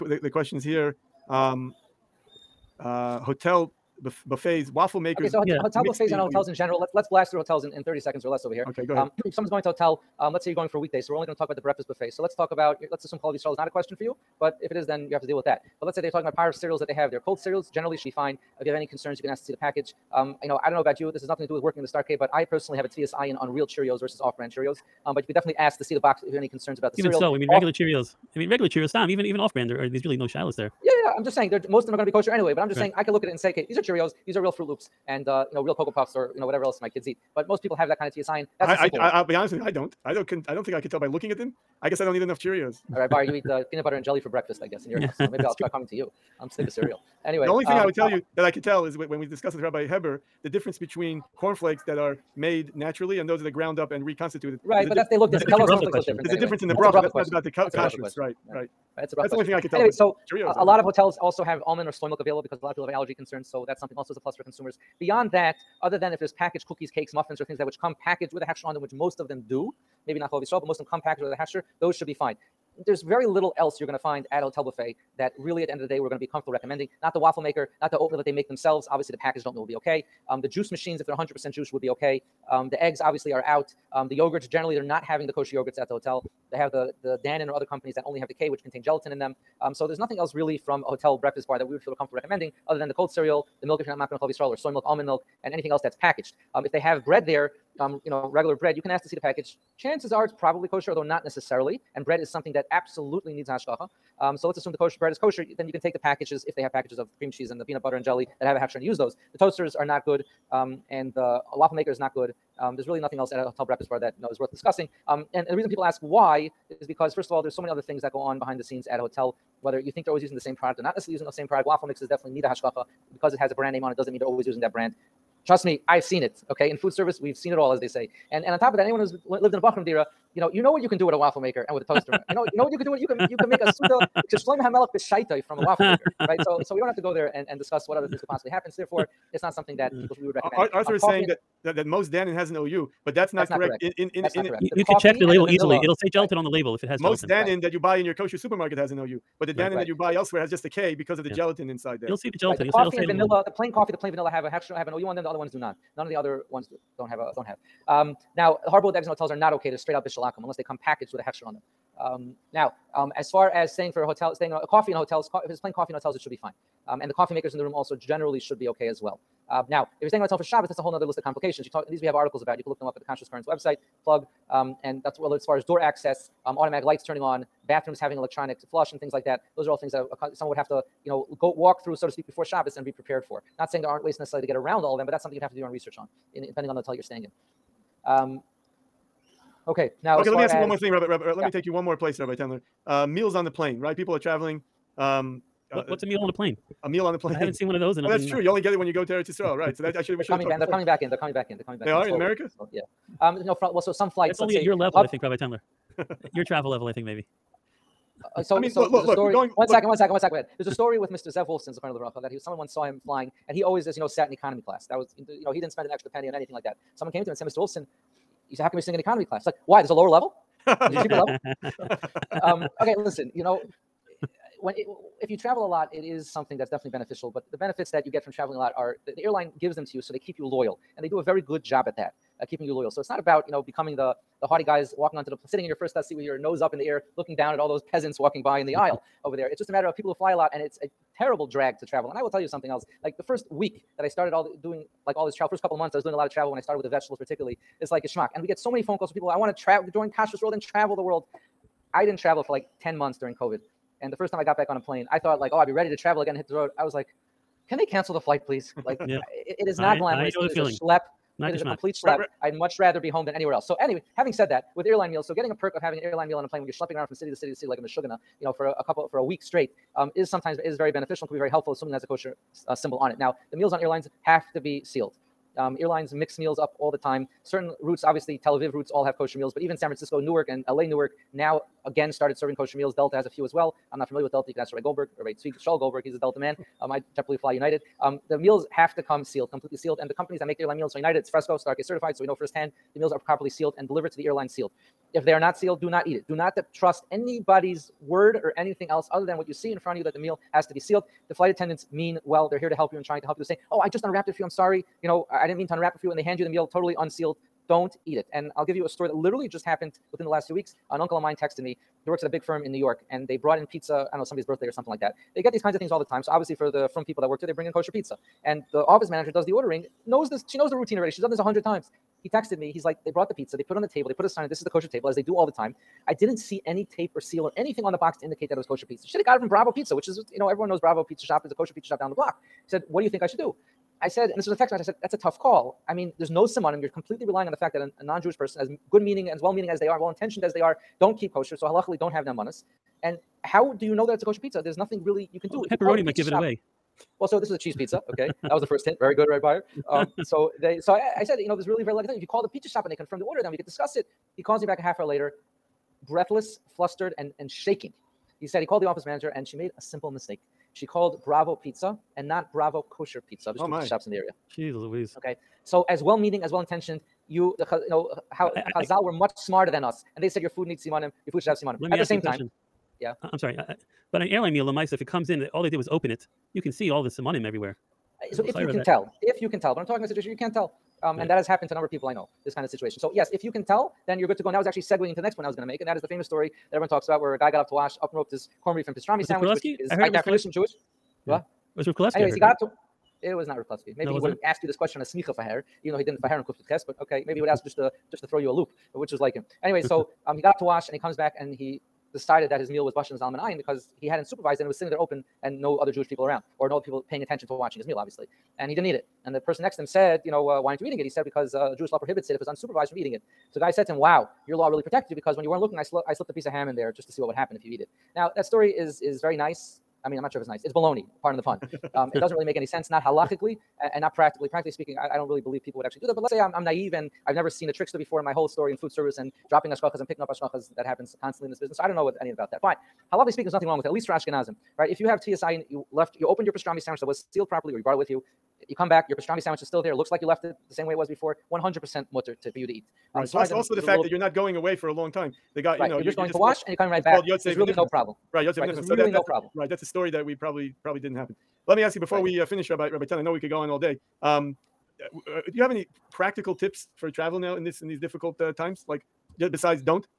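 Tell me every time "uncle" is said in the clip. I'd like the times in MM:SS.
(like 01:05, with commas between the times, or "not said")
05:10.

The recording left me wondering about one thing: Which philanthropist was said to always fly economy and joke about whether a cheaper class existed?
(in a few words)
Zev Wolfson.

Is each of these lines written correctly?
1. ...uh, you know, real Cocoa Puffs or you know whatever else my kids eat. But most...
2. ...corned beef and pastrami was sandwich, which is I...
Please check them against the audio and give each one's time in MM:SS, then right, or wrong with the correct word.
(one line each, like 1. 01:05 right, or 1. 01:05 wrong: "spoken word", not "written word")
1. 00:35 right
2. 06:28 right.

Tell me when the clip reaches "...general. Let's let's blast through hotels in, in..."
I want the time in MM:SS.
00:06.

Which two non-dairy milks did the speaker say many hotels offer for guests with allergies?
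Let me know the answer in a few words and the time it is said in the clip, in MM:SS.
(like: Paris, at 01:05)
almond or soy milk, at 01:01.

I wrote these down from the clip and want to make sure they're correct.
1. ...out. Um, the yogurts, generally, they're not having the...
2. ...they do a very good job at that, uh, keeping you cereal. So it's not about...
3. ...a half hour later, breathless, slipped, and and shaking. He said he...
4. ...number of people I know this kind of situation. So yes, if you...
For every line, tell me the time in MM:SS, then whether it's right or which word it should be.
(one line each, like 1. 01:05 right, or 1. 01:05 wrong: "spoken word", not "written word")
1. 01:23 right
2. 03:51 wrong: "loyal", not "cereal"
3. 05:54 wrong: "flustered", not "slipped"
4. 06:21 right.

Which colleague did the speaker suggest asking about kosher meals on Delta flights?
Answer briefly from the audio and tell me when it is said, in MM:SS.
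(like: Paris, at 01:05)
Rabbi Shaul Goldberg, at 04:45.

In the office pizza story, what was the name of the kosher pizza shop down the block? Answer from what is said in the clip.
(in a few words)
Bravo Kosher Pizza.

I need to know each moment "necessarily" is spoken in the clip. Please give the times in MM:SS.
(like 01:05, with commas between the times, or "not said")
01:41, 02:00, 03:04.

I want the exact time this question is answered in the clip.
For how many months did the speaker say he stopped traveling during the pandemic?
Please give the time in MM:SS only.
04:12.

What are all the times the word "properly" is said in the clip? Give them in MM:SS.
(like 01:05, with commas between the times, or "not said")
04:53, 07:17.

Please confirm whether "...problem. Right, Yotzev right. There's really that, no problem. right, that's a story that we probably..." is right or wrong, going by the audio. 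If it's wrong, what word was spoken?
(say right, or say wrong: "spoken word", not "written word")
right.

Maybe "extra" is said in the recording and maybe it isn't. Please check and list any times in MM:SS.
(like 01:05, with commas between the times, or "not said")
02:34, 03:35.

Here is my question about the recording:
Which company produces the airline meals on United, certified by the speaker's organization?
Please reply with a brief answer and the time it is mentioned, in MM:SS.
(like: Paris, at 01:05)
Fresco, at 04:51.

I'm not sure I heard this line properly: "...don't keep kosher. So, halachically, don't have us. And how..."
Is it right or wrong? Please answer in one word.
right.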